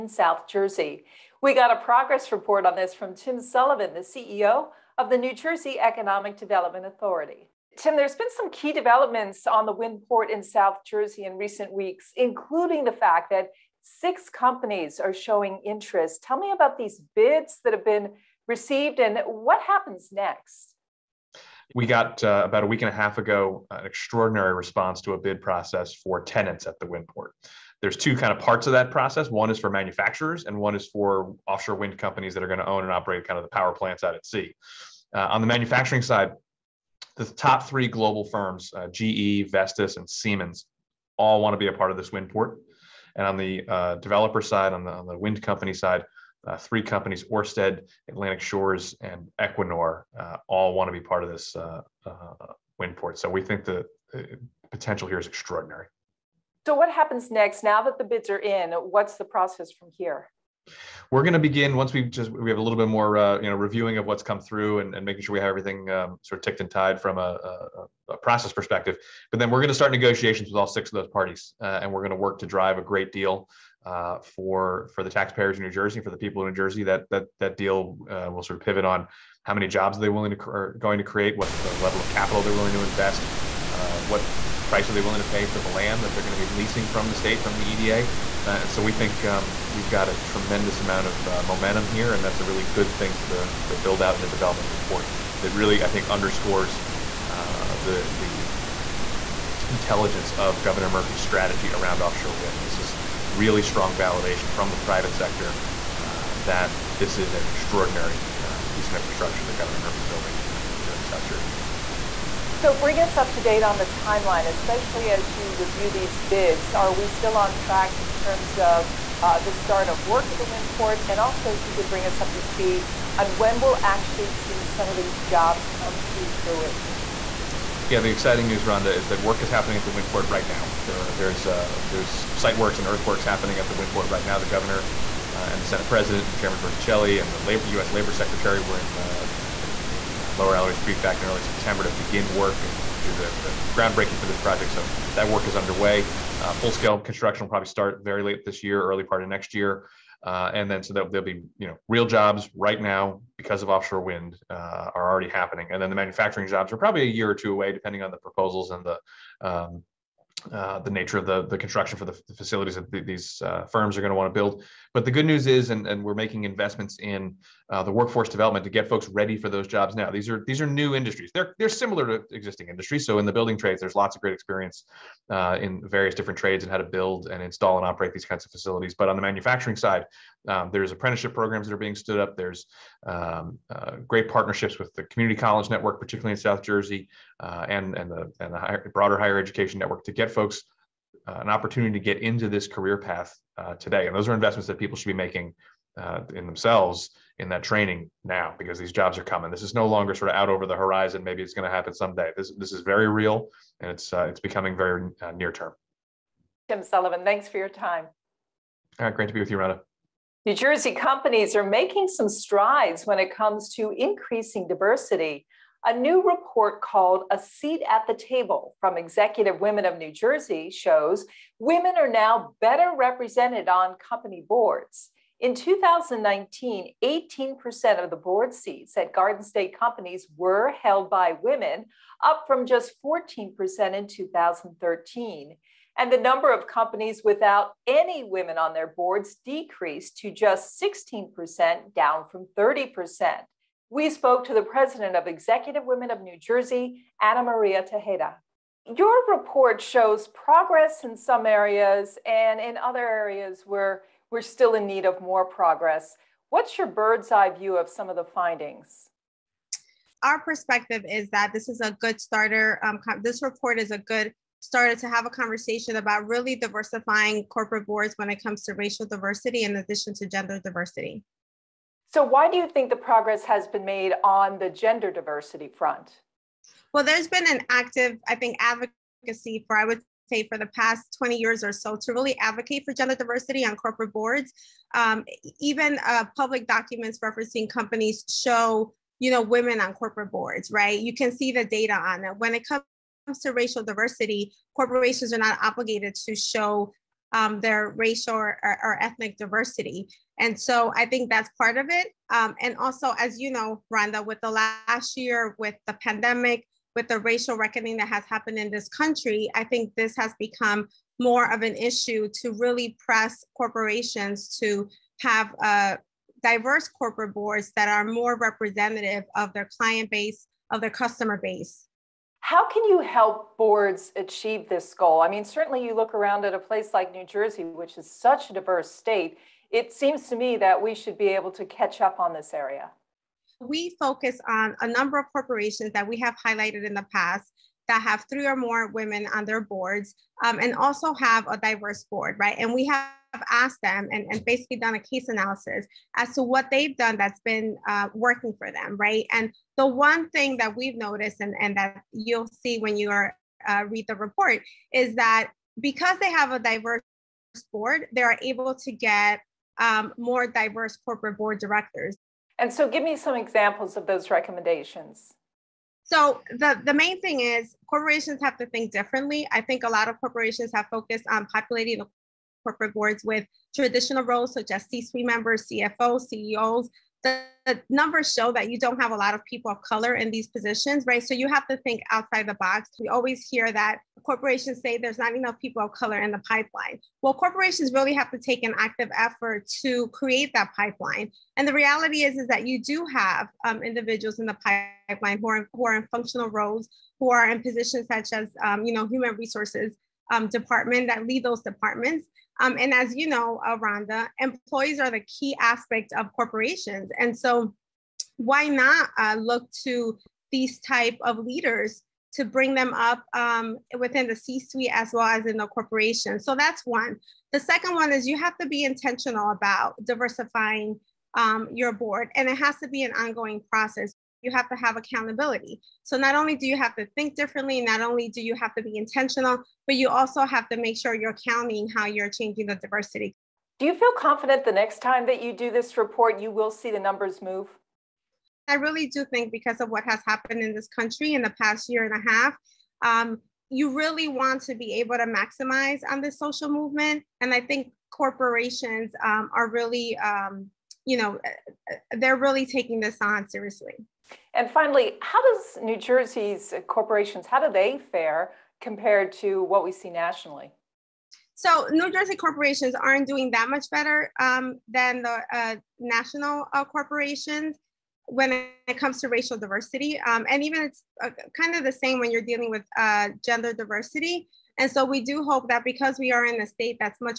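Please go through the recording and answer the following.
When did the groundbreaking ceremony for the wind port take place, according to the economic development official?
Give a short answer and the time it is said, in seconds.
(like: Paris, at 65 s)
Early September, at 141 s.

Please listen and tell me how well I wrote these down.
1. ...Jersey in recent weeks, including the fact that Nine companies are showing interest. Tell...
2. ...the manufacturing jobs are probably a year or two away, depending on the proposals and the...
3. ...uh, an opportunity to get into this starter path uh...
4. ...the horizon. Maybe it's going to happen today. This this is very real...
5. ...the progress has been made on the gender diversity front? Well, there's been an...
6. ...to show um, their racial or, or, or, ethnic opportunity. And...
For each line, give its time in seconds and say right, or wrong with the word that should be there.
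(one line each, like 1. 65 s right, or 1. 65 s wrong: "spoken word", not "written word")
1. 10 s wrong: "Six", not "Nine"
2. 155 s right
3. 191 s wrong: "career", not "starter"
4. 200 s wrong: "someday", not "today"
5. 272 s right
6. 296 s wrong: "diversity", not "opportunity".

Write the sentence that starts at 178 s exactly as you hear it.
But on the manufacturing side, um, there's apprenticeship programs that are being stood up.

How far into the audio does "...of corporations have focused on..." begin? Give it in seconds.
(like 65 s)
370 s.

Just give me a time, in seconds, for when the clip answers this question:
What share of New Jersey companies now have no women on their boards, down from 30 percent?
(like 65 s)
240 s.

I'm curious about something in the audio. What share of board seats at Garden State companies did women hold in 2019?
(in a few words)
18%.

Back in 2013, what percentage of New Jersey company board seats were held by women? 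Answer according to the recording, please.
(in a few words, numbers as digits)
14%.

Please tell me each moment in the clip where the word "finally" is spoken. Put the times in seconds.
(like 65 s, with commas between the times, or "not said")
454 s.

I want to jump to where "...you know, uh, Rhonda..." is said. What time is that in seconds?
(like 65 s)
403 s.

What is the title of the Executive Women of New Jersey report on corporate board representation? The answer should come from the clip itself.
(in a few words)
A Seat at the Table.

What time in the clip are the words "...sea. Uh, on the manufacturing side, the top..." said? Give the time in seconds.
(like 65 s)
34 s.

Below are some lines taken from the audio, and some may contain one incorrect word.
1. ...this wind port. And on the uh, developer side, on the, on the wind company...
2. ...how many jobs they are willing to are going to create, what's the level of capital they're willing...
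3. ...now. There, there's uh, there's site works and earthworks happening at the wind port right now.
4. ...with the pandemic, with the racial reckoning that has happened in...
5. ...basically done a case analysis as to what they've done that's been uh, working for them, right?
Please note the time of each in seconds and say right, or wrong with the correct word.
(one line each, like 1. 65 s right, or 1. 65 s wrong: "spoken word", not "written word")
1. 41 s right
2. 79 s right
3. 130 s right
4. 305 s right
5. 344 s right.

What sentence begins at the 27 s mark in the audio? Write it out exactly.
There's two kind of parts of that process.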